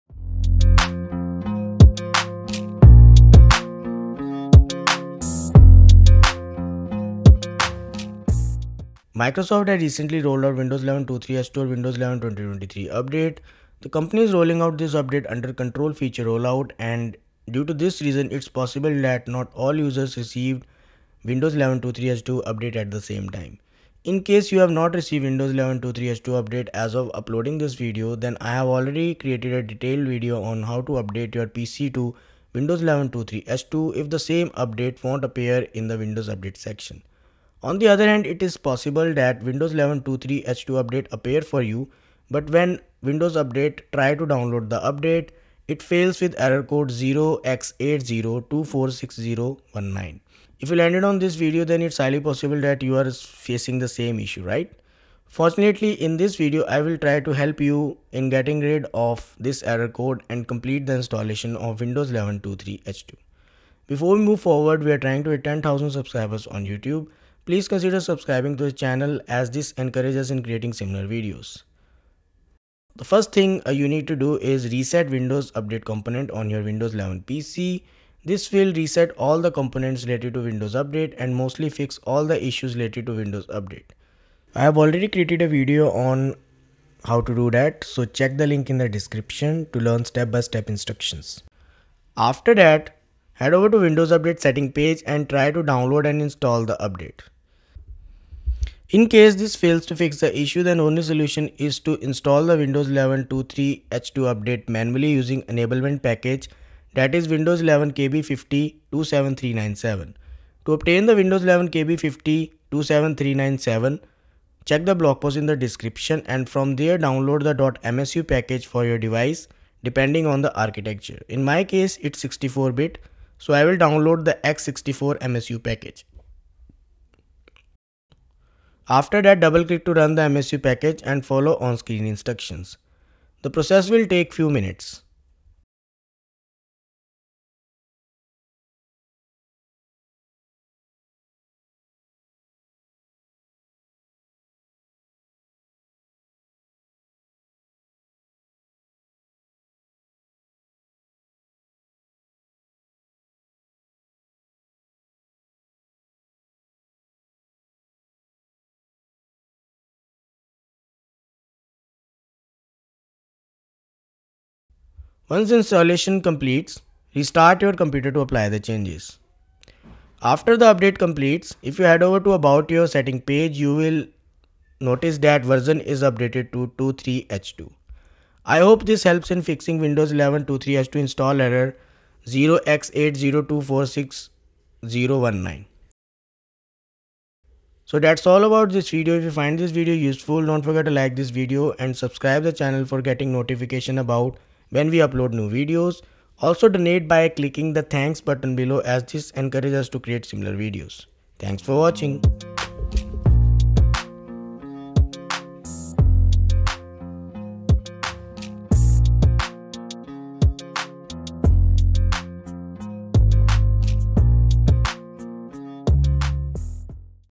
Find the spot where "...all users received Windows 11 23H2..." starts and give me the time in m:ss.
0:19.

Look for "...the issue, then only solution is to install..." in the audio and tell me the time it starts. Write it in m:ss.
1:40.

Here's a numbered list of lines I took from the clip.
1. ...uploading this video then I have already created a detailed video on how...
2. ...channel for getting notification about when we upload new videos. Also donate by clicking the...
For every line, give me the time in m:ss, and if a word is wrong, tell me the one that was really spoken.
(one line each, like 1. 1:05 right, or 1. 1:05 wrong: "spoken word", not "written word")
1. 0:27 right
2. 3:12 right.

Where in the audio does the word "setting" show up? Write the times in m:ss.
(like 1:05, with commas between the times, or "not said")
1:34, 2:52.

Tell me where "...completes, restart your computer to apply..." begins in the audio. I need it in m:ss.
2:46.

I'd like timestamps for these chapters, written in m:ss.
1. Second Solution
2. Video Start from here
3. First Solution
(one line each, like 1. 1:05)
1. 1:38
2. 0:38
3. 0:54.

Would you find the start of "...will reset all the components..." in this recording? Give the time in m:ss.
1:18.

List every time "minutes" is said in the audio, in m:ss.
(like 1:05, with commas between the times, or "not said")
2:14.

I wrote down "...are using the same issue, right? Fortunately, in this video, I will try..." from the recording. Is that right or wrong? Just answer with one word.
wrong.